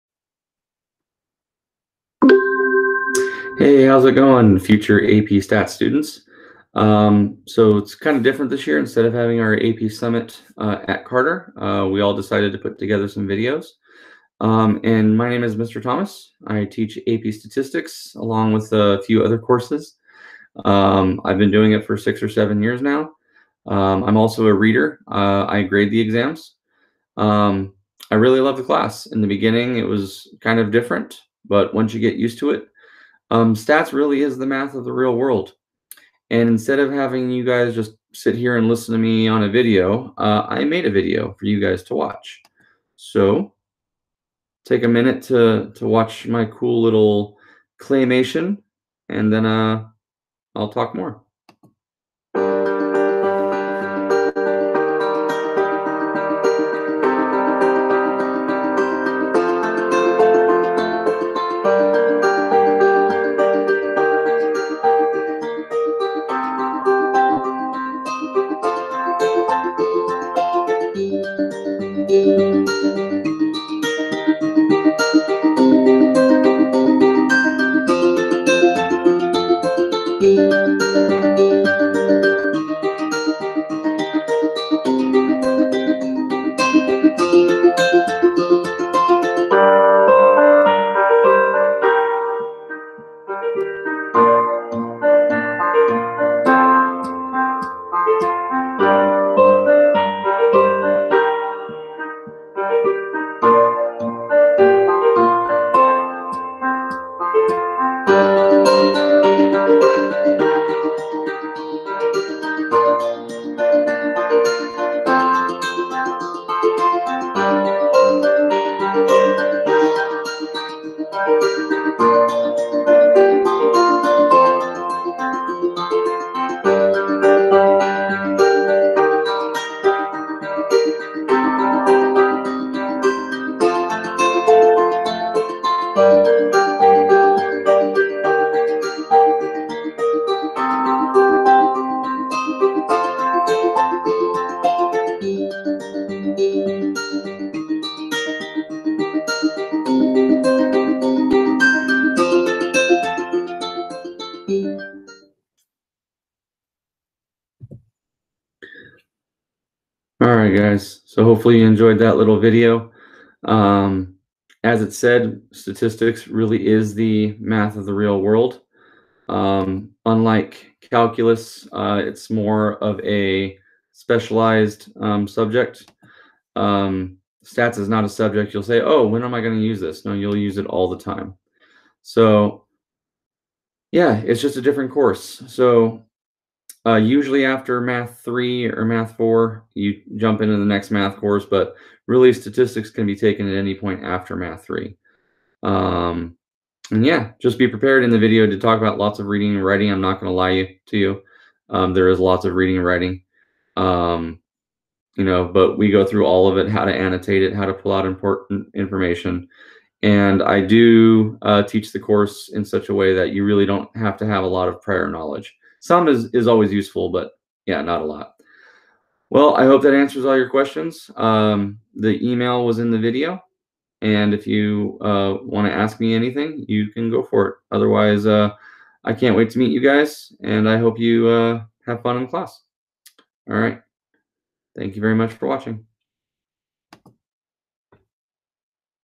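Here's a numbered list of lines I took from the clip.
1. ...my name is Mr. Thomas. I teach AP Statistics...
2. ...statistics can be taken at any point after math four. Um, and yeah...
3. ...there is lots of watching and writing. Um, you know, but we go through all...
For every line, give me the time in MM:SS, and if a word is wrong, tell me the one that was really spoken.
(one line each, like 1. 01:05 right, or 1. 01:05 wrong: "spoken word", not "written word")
1. 00:15 right
2. 03:12 wrong: "three", not "four"
3. 03:21 wrong: "reading", not "watching".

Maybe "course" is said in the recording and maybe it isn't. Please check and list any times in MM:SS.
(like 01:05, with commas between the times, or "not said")
00:19, 03:04, 03:11, 03:31.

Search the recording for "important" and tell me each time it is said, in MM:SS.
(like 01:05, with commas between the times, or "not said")
03:28.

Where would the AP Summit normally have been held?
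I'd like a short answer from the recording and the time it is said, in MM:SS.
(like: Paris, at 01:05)
Carter, at 00:11.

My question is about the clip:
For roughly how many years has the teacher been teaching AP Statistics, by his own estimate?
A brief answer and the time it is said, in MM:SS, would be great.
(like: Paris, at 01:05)
6 or 7, at 00:21.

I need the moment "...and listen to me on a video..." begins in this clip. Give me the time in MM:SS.
00:38.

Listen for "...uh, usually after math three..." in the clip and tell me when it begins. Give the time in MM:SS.
03:06.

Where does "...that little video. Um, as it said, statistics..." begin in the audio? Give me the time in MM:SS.
02:41.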